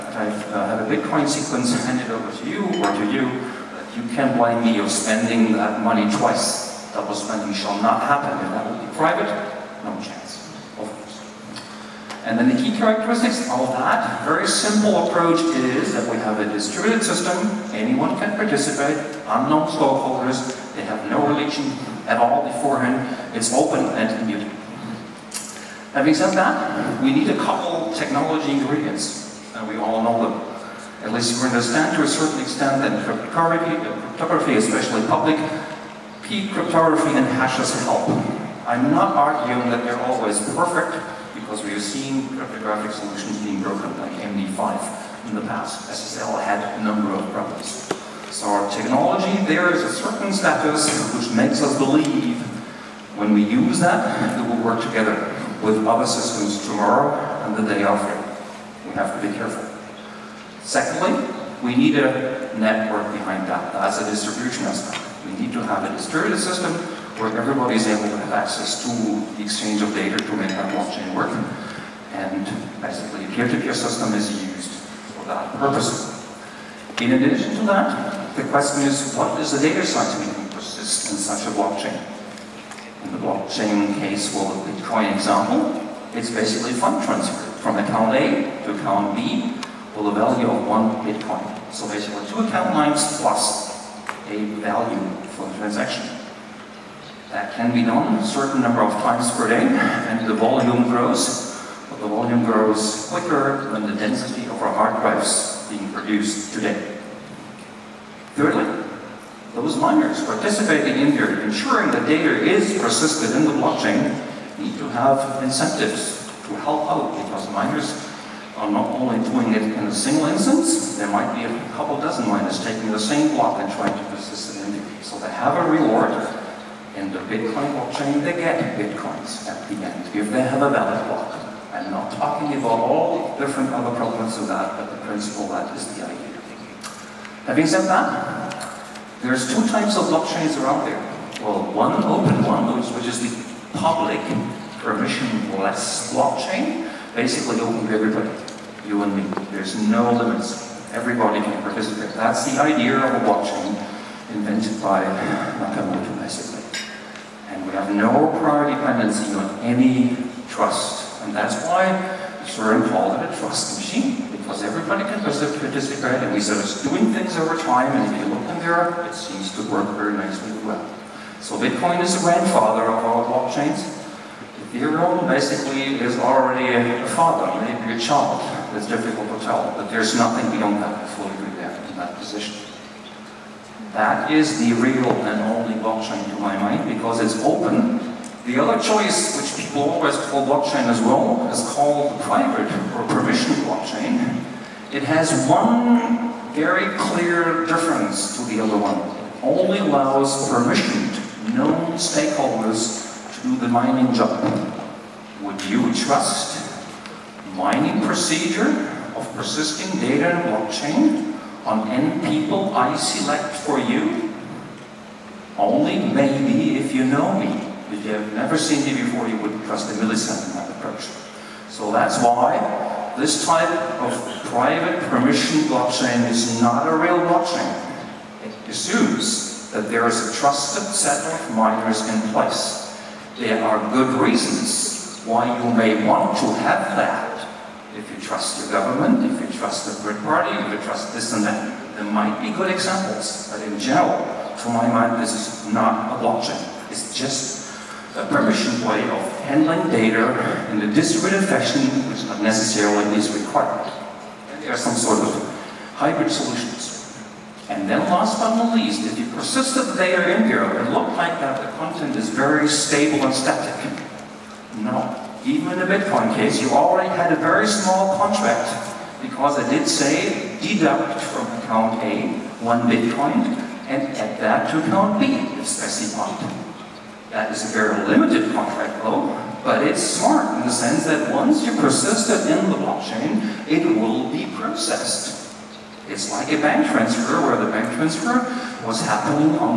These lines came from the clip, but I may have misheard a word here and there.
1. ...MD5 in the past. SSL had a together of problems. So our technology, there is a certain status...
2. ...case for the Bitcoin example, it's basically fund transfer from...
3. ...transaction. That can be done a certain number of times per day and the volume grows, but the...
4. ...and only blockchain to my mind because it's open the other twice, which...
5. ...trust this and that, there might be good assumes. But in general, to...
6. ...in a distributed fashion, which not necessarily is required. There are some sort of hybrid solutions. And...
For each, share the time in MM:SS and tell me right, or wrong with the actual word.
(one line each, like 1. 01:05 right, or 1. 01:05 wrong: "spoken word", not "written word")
1. 00:44 wrong: "number", not "together"
2. 01:23 right
3. 01:35 right
4. 03:05 wrong: "choice", not "twice"
5. 04:00 wrong: "examples", not "assumes"
6. 04:10 right.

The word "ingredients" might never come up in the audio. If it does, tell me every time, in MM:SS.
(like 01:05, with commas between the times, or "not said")
00:28.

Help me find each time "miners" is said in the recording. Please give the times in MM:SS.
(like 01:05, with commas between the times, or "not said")
01:49, 01:57, 02:02, 03:51.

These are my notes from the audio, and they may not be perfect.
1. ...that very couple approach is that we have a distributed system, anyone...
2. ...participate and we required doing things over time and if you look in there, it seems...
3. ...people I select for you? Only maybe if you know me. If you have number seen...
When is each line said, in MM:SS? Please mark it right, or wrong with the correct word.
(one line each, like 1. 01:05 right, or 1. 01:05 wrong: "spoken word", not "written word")
1. 00:13 wrong: "simple", not "couple"
2. 02:45 wrong: "started", not "required"
3. 03:32 wrong: "never", not "number".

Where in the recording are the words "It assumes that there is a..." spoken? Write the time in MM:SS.
03:48.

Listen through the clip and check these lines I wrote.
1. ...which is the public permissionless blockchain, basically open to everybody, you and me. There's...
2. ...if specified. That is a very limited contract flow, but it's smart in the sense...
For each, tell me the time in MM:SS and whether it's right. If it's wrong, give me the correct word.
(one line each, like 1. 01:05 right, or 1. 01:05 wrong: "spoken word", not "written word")
1. 02:22 right
2. 04:35 right.